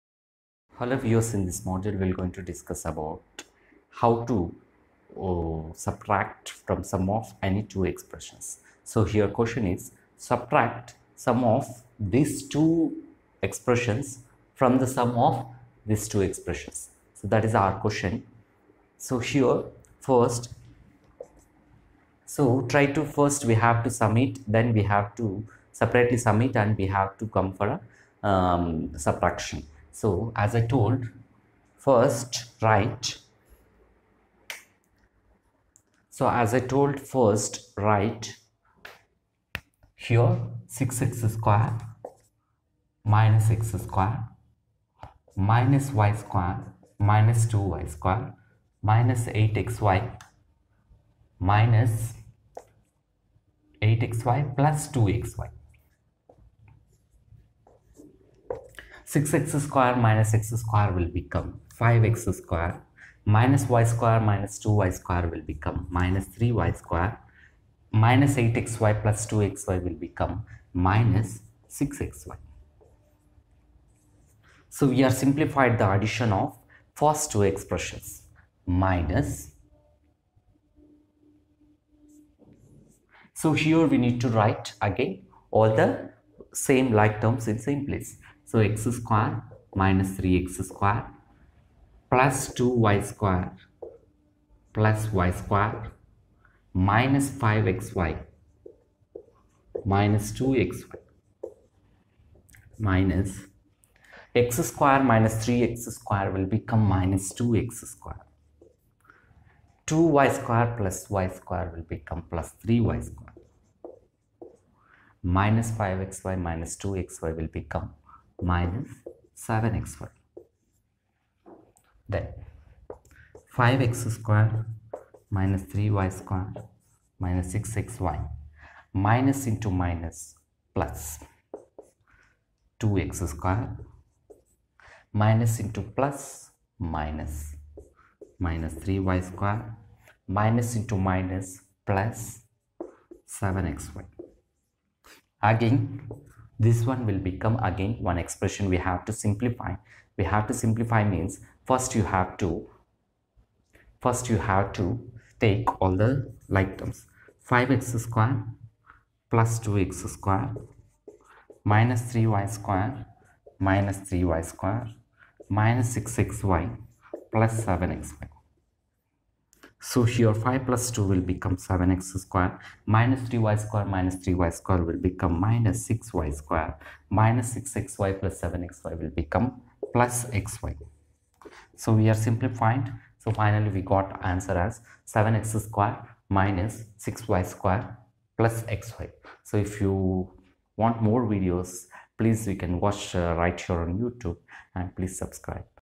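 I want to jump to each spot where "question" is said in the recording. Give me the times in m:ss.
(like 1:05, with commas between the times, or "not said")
0:09, 0:17.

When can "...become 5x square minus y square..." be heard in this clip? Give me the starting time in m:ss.
1:01.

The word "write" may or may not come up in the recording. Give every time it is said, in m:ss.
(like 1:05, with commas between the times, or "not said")
0:32, 0:37, 1:24.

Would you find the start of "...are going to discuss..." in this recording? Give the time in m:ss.
0:02.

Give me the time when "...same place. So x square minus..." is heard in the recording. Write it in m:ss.
1:27.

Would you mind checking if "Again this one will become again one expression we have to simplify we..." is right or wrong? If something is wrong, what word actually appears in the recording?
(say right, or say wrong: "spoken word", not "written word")
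right.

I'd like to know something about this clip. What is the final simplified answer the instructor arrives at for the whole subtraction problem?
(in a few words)
7x² - 6y² + xy.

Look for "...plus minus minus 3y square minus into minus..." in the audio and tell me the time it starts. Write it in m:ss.
2:15.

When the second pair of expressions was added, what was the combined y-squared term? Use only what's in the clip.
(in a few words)
+3y².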